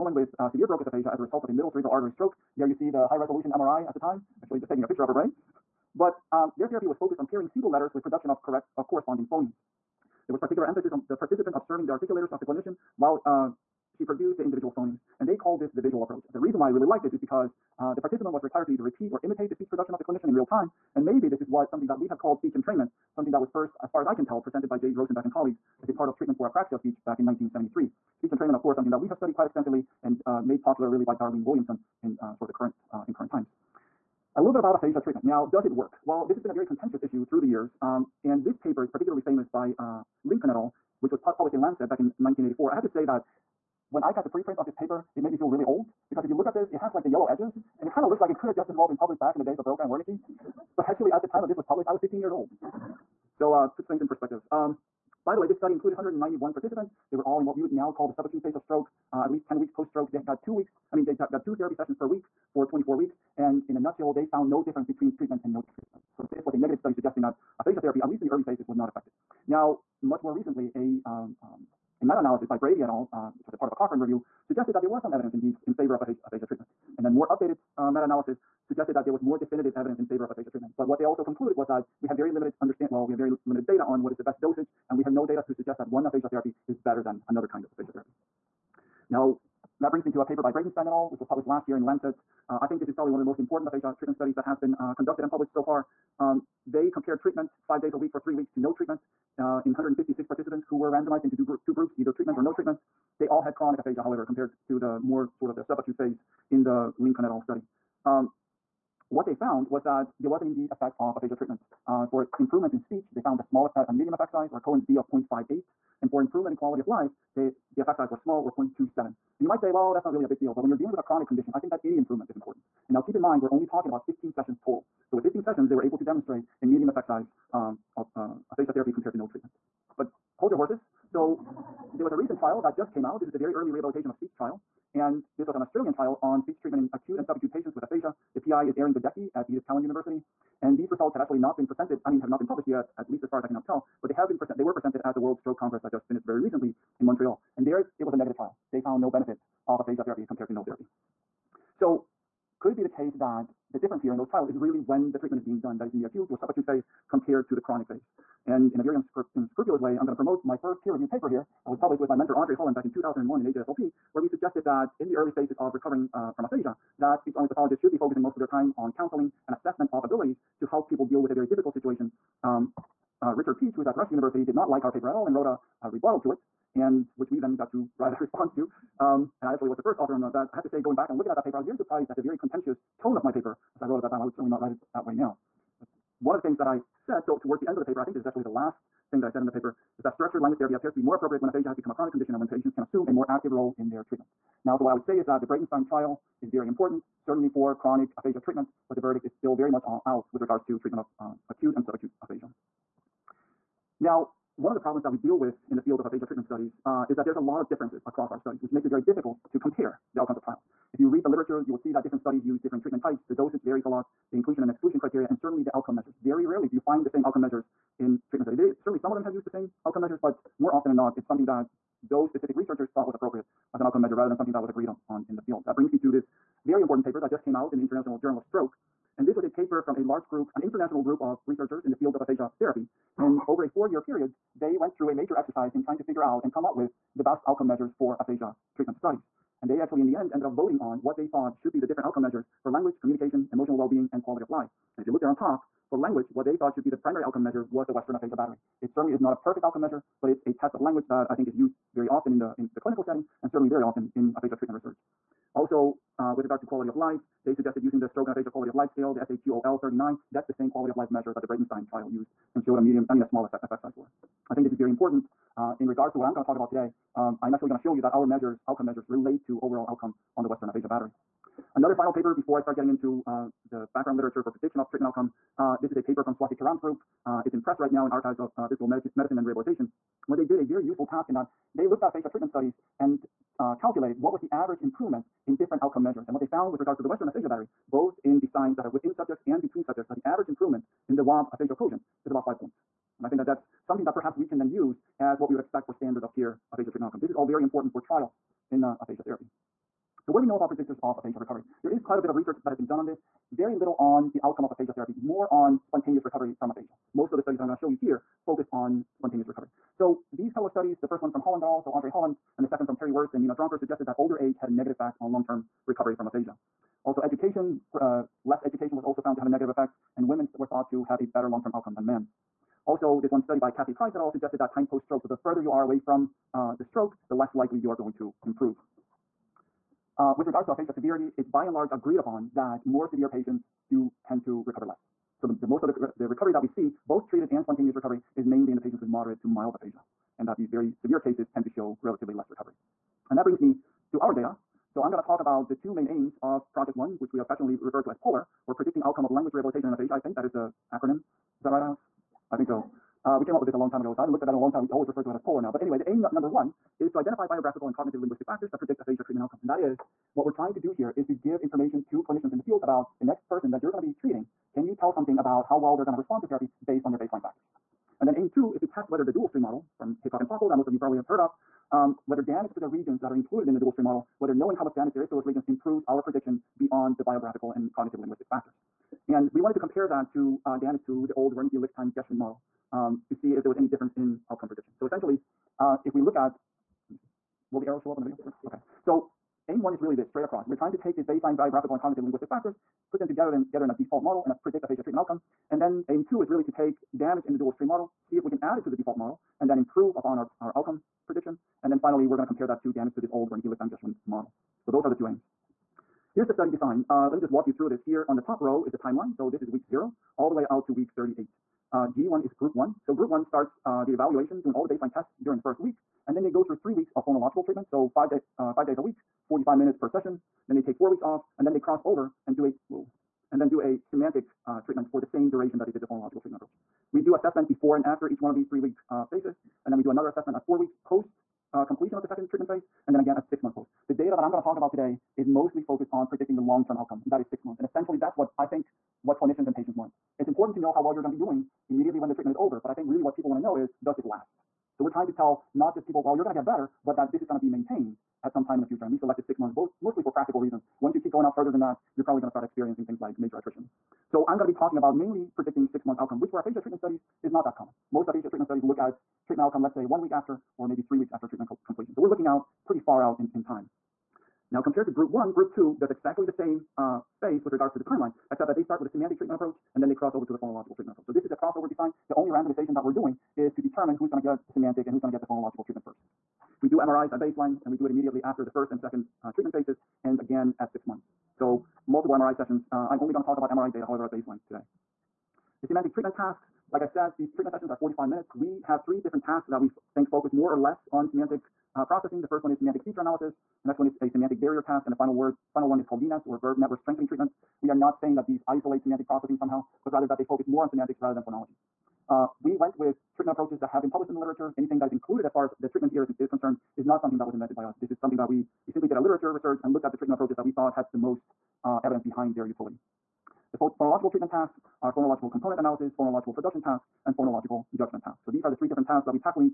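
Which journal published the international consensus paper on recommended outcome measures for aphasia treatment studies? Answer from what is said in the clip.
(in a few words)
International Journal of Stroke.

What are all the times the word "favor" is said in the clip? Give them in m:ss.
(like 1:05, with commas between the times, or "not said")
1:15, 1:20.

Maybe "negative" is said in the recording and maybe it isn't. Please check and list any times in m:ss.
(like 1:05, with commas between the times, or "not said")
1:06, 2:28, 5:14, 5:19.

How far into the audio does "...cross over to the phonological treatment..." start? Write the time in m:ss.
7:50.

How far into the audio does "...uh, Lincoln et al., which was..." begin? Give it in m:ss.
0:39.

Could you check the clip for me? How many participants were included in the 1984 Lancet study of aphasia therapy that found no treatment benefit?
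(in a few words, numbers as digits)
191.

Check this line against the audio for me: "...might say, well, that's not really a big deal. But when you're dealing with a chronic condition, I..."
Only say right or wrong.
right.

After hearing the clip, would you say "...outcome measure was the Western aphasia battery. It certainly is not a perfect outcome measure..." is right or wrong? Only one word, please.
right.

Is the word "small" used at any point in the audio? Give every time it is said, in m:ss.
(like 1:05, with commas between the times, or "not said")
1:53, 1:58, 4:23.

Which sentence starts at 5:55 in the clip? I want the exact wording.
But anyway, the aim number one is to identify biographical and cognitive linguistic factors that predict aphasia treatment outcome.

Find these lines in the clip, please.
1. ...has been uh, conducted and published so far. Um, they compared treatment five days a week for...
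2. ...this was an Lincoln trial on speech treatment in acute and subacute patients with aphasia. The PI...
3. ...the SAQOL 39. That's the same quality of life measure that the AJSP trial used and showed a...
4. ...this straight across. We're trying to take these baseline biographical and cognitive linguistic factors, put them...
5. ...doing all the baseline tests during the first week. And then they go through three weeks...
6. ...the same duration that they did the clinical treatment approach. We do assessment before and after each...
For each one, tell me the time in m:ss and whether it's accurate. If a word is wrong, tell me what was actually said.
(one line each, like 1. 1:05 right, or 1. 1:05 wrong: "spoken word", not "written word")
1. 1:34 right
2. 2:15 wrong: "Australian", not "Lincoln"
3. 4:19 wrong: "Breitenstein", not "AJSP"
4. 6:30 right
5. 6:54 right
6. 7:05 wrong: "phonological", not "clinical".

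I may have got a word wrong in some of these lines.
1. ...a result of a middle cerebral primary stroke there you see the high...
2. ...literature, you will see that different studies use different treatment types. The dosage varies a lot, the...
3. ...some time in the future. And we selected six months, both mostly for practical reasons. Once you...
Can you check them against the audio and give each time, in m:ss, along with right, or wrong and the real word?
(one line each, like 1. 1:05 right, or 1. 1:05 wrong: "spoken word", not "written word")
1. 0:01 wrong: "artery", not "primary"
2. 3:31 right
3. 7:28 right.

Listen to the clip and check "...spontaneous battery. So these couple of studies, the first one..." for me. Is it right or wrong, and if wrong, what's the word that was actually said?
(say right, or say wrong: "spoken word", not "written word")
wrong: "recovery", not "battery".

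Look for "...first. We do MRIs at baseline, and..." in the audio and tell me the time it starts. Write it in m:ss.
7:56.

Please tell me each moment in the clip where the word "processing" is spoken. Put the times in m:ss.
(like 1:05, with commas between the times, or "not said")
8:12, 8:19.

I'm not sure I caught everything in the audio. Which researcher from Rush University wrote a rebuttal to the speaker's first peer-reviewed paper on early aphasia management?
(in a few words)
Richard Peach.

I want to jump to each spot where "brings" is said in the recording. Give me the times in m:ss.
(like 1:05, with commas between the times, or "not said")
1:29, 3:45, 5:43.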